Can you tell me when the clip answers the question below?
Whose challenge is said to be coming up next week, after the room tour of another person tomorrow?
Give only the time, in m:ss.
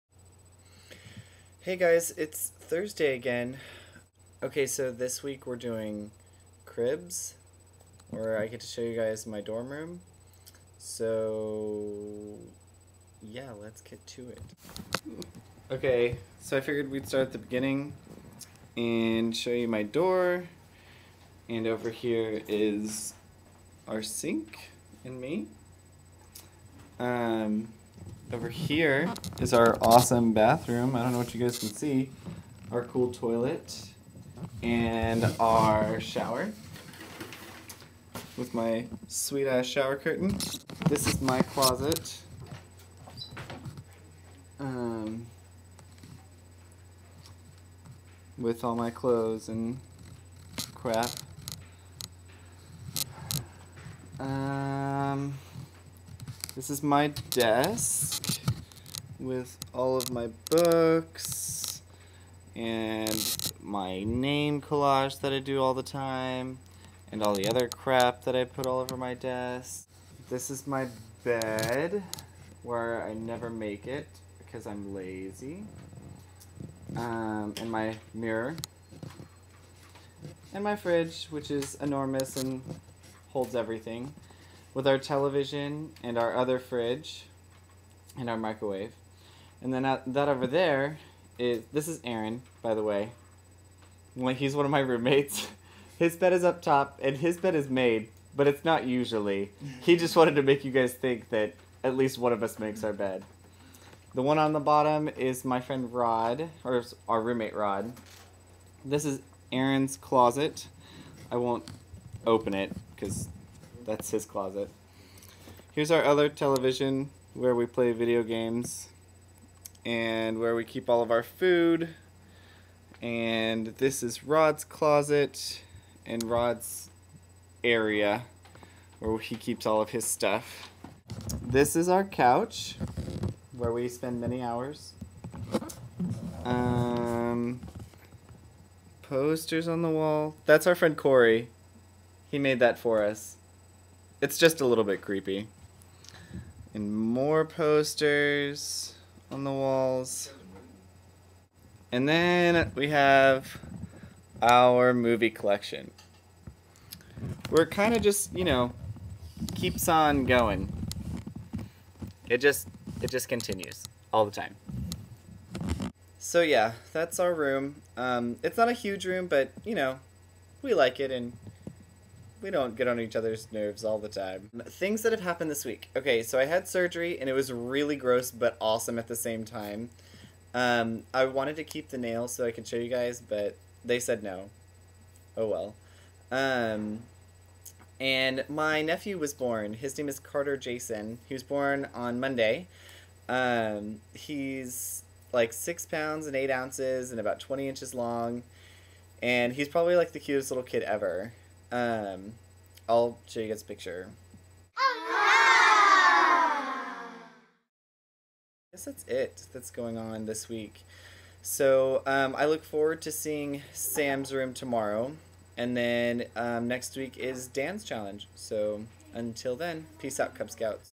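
3:37.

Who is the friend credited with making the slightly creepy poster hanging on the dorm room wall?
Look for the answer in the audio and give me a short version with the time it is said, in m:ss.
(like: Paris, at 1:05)
Corey, at 2:20.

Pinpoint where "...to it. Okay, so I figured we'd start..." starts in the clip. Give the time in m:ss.
0:14.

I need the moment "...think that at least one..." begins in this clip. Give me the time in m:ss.
1:40.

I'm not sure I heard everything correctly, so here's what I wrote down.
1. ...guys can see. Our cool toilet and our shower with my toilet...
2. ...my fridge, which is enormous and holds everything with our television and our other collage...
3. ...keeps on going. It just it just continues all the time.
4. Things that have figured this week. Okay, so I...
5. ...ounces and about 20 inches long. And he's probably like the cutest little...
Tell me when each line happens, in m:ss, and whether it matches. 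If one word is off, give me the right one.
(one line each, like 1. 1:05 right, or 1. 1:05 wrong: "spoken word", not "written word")
1. 0:31 wrong: "sweet", not "toilet"
2. 1:20 wrong: "fridge", not "collage"
3. 2:39 right
4. 2:54 wrong: "happened", not "figured"
5. 3:16 right.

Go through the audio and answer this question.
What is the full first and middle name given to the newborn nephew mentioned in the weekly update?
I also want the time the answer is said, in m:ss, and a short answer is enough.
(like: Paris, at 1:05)
Carter Jason, at 3:10.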